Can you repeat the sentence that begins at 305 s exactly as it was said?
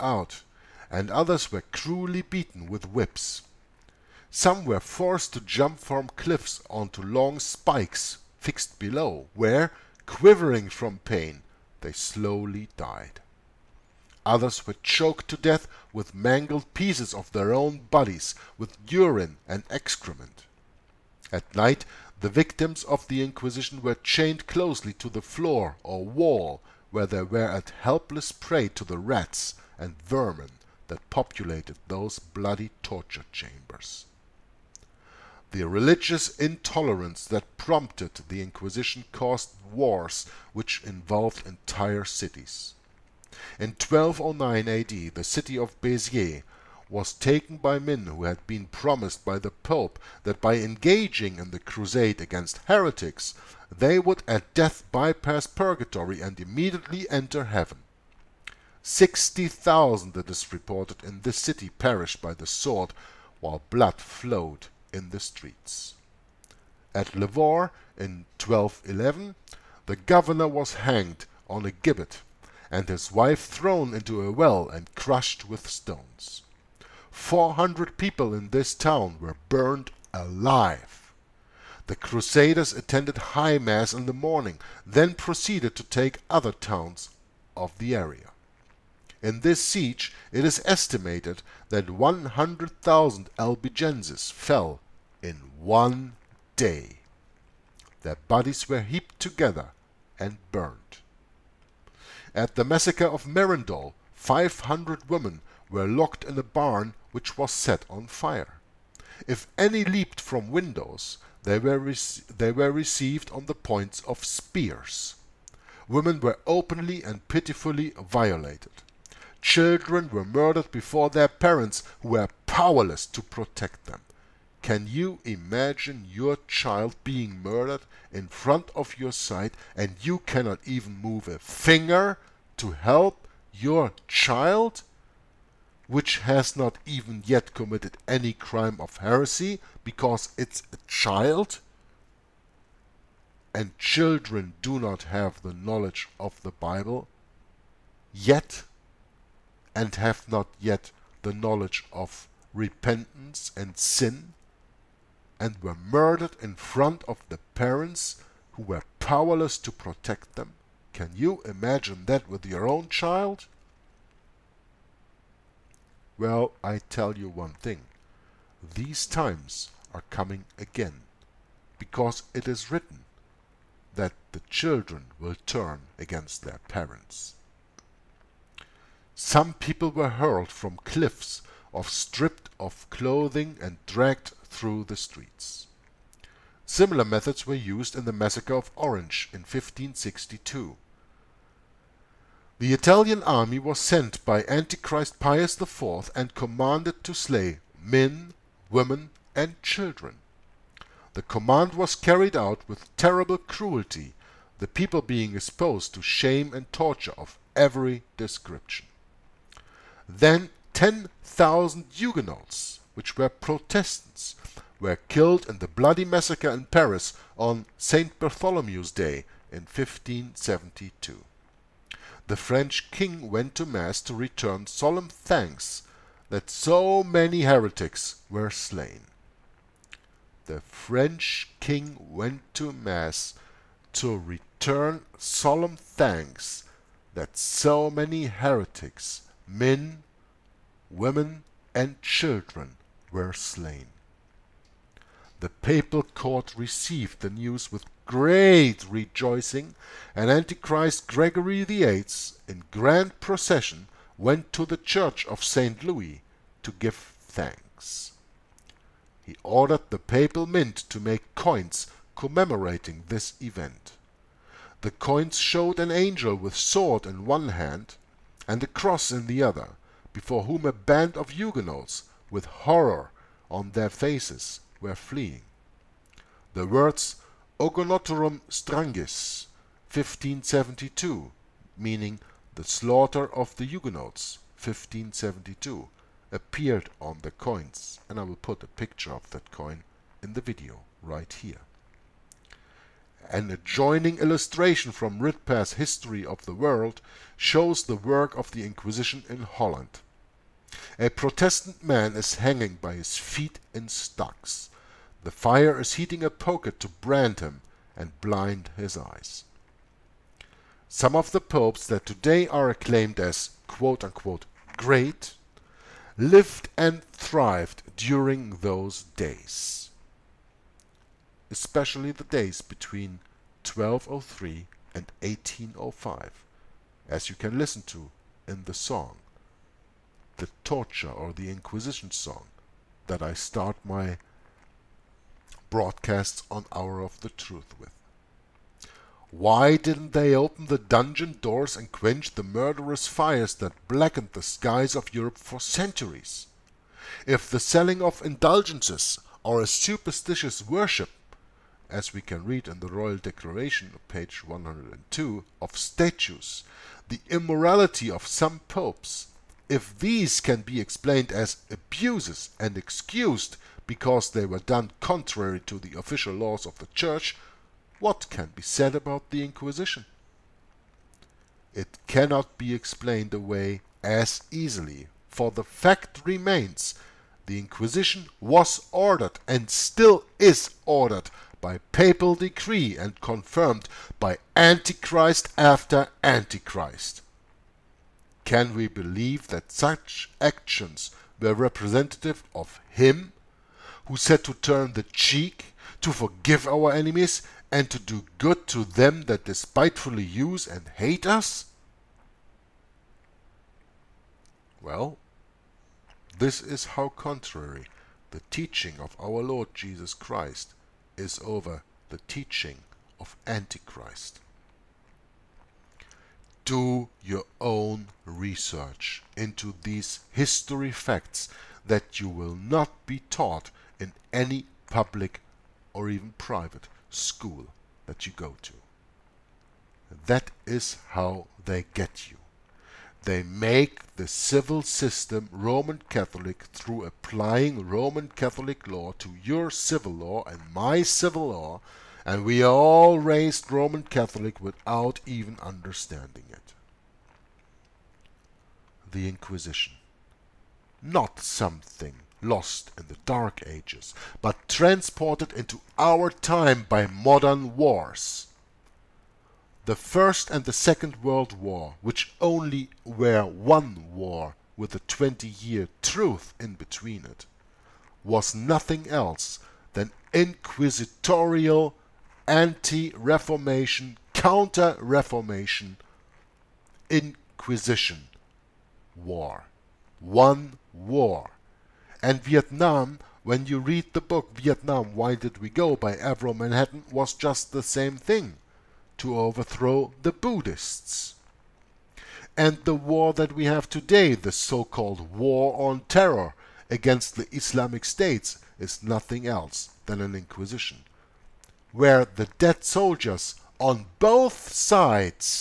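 The fire is heating a poker to brand him and blind his eyes.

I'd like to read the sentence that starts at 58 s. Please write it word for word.
Sixty thousand, it is reported, in this city perished by the sword, while blood flowed in the streets.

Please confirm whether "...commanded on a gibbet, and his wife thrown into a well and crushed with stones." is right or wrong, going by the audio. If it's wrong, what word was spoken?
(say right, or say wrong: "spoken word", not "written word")
wrong: "hanged", not "commanded".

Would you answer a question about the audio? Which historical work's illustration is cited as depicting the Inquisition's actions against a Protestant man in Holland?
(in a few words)
Ridpath's History of the World.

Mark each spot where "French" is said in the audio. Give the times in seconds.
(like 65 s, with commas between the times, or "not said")
222 s, 230 s.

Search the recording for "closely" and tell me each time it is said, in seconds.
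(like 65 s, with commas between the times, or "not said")
24 s.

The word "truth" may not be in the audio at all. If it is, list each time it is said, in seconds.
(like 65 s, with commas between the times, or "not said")
337 s, 466 s.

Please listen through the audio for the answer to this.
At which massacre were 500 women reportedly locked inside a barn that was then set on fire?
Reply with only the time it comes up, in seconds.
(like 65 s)
103 s.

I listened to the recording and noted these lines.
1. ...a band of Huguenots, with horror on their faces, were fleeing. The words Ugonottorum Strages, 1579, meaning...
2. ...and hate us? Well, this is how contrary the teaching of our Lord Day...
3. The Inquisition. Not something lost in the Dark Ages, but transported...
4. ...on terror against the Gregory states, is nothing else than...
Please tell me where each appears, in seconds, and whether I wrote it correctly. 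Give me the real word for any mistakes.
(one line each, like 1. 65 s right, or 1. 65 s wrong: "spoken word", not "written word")
1. 270 s wrong: "1572", not "1579"
2. 400 s wrong: "Jesus", not "Day"
3. 449 s right
4. 495 s wrong: "Islamic", not "Gregory".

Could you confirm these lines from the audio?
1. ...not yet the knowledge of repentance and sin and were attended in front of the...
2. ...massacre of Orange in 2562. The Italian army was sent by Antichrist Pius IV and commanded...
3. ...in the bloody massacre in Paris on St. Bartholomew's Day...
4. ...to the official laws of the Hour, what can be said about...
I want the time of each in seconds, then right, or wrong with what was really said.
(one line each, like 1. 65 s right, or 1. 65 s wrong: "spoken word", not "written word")
1. 150 s wrong: "murdered", not "attended"
2. 188 s wrong: "1562", not "2562"
3. 215 s right
4. 365 s wrong: "Church", not "Hour".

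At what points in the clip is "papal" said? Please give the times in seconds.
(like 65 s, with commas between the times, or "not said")
245 s, 259 s, 381 s.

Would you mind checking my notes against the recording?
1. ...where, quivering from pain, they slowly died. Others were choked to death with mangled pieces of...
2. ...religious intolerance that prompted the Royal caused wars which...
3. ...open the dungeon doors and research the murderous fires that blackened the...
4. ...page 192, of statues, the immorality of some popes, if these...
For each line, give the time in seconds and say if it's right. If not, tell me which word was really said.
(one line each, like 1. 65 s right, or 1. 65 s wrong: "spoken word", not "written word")
1. 9 s right
2. 35 s wrong: "Inquisition", not "Royal"
3. 340 s wrong: "quench", not "research"
4. 354 s wrong: "102", not "192".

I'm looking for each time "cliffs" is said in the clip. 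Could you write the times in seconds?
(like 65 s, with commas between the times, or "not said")
6 s, 180 s.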